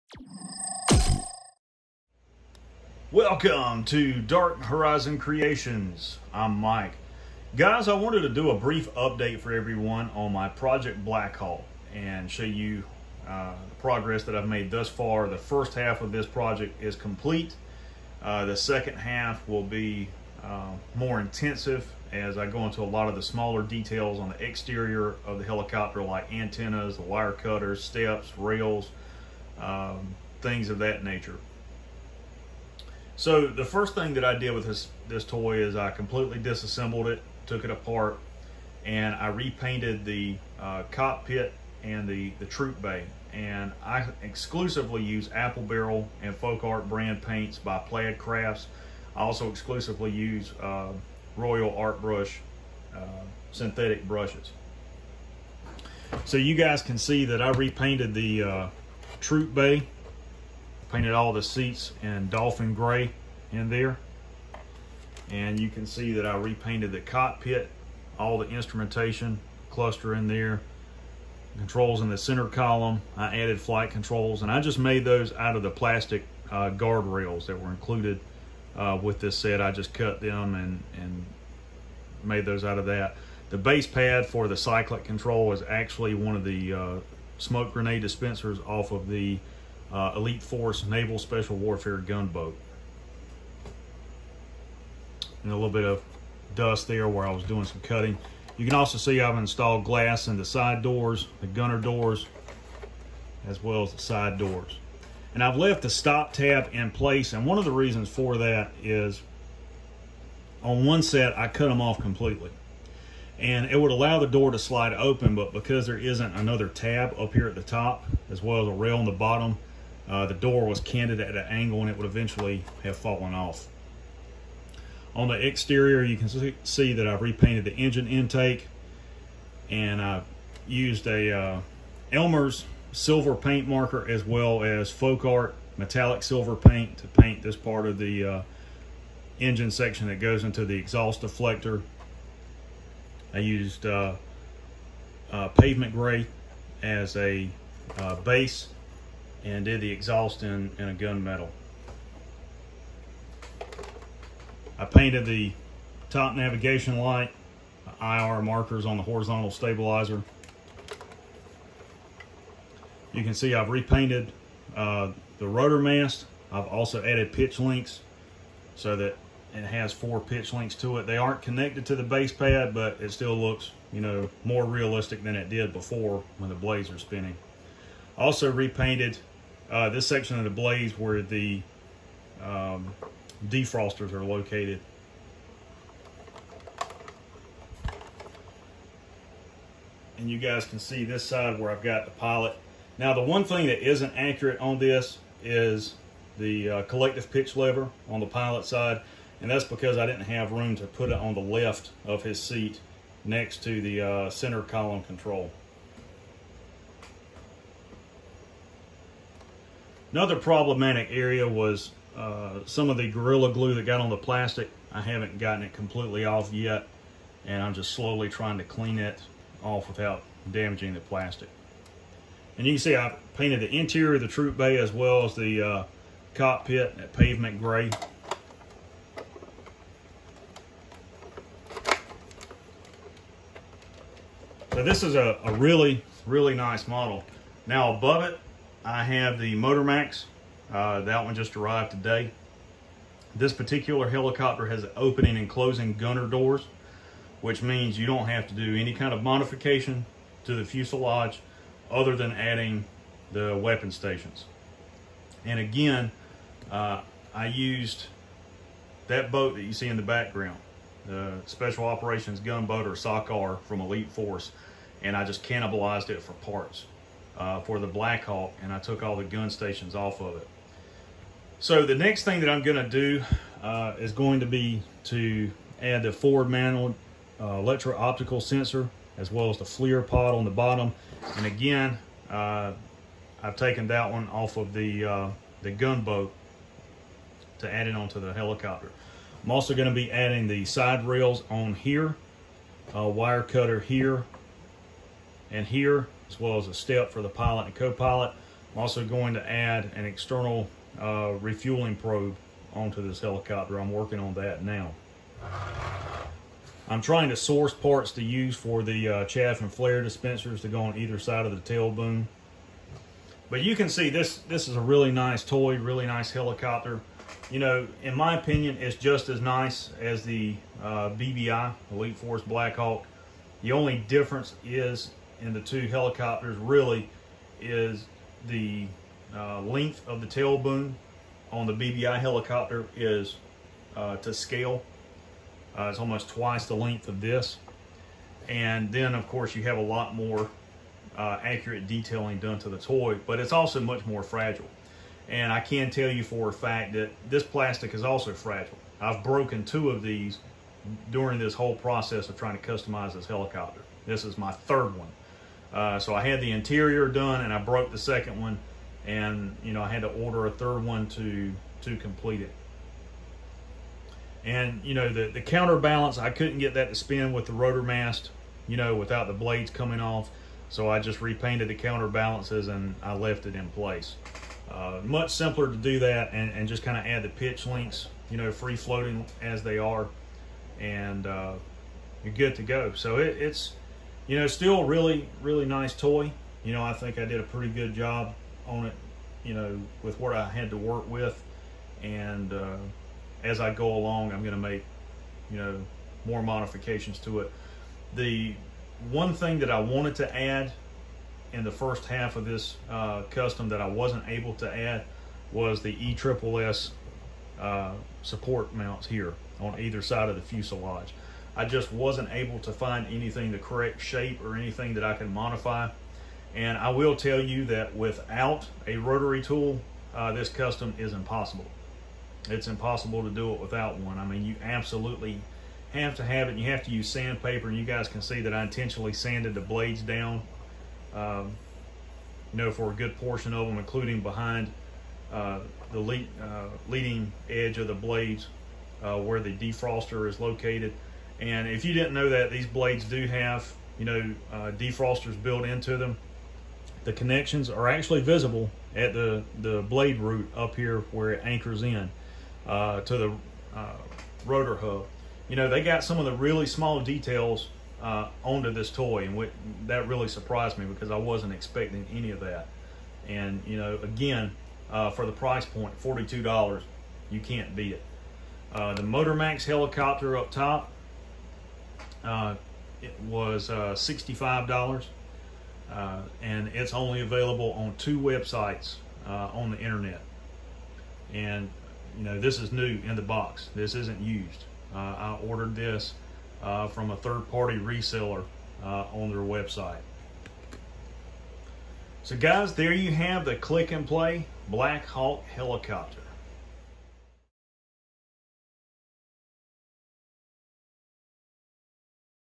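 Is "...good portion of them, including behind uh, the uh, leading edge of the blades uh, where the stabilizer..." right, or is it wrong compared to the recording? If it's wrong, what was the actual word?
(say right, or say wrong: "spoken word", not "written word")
wrong: "defroster", not "stabilizer".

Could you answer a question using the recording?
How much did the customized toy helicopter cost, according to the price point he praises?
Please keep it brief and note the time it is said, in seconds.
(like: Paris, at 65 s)
$42, at 466 s.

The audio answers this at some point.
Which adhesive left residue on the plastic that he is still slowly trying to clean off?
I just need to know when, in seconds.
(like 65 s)
213 s.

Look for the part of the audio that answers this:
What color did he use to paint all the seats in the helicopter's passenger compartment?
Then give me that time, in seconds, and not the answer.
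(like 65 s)
62 s.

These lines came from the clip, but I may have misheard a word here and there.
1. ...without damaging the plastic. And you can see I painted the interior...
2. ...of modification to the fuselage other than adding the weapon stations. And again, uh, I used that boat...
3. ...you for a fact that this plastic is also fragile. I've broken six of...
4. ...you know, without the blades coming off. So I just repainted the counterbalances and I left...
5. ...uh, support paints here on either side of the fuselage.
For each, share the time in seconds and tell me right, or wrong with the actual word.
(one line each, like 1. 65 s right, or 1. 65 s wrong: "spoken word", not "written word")
1. 219 s right
2. 249 s right
3. 346 s wrong: "two", not "six"
4. 368 s right
5. 407 s wrong: "mounts", not "paints".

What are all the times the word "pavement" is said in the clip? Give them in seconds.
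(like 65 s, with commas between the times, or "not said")
145 s, 227 s.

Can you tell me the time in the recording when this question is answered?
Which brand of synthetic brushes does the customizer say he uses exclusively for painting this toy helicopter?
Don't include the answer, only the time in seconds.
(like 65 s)
51 s.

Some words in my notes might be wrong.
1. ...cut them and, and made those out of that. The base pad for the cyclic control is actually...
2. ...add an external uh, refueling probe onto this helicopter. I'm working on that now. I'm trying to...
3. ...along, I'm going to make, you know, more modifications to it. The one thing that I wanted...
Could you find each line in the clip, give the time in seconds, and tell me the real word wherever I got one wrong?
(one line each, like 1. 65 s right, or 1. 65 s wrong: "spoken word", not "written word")
1. 79 s right
2. 299 s right
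3. 393 s right.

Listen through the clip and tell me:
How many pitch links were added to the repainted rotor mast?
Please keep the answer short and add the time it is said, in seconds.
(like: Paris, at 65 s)
4, at 169 s.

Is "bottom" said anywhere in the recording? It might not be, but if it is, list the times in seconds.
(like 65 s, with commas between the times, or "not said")
119 s, 280 s.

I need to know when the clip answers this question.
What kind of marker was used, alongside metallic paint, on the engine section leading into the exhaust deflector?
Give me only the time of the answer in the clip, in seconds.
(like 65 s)
132 s.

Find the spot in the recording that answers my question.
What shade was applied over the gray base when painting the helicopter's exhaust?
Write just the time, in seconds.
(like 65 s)
150 s.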